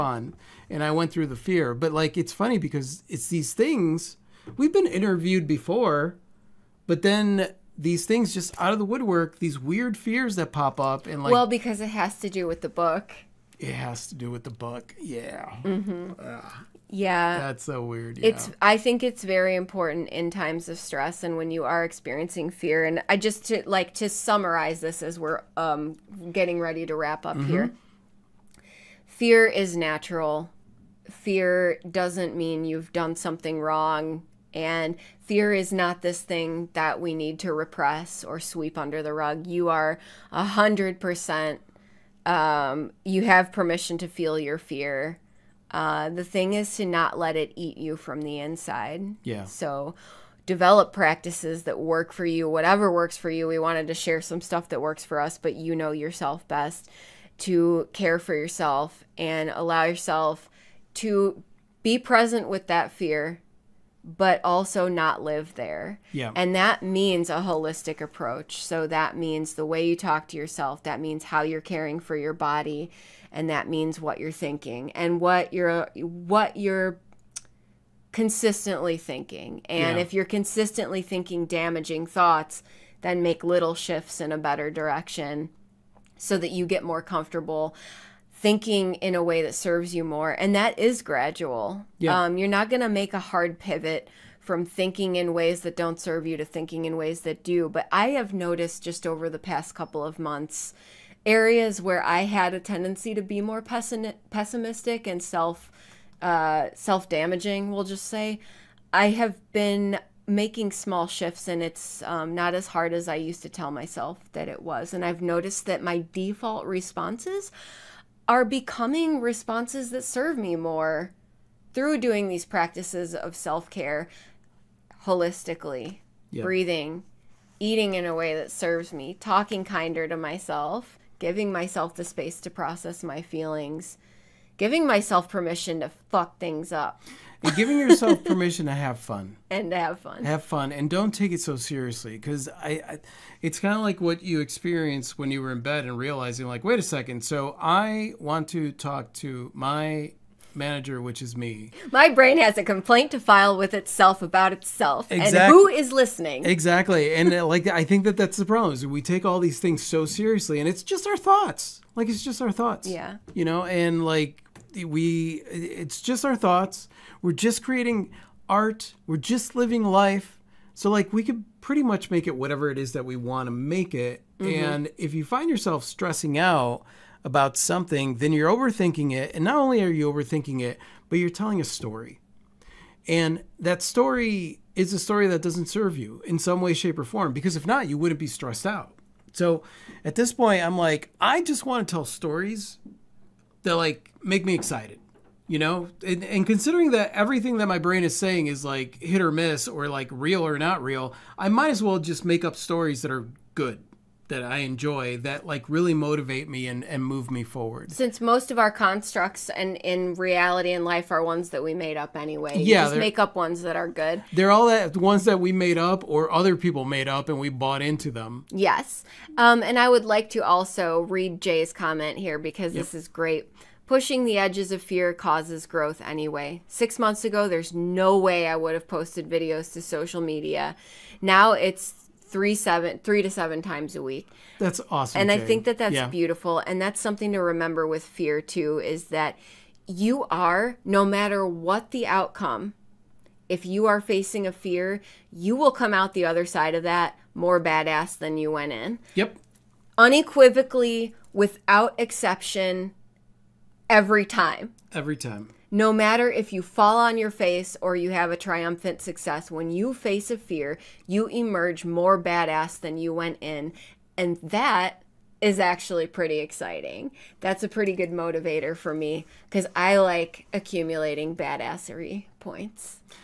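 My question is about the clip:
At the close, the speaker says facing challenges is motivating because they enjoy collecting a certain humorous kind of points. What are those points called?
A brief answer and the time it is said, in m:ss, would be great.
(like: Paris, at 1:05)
badassery points, at 4:31.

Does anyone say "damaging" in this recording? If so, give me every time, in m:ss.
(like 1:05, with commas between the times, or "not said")
1:21, 1:47.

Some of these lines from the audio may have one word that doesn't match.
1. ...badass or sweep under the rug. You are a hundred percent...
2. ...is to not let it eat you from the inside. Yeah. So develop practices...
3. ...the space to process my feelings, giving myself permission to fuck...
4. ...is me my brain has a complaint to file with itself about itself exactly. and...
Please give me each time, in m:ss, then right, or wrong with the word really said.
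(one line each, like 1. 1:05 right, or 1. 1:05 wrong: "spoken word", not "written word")
1. 0:37 wrong: "repress", not "badass"
2. 0:46 right
3. 2:11 right
4. 2:31 right.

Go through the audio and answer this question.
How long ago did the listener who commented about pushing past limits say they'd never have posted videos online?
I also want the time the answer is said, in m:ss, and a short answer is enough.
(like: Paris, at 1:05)
6 months ago, at 3:46.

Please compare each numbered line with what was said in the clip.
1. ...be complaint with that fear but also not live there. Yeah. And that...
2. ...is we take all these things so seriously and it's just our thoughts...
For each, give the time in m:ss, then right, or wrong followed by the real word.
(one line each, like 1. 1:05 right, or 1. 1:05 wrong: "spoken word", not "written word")
1. 1:01 wrong: "present", not "complaint"
2. 2:38 right.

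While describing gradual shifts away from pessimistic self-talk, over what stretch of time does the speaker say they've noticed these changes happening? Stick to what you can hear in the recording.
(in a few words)
past couple of months.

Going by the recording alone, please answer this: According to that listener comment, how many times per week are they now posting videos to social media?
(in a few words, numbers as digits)
3 to 7 times.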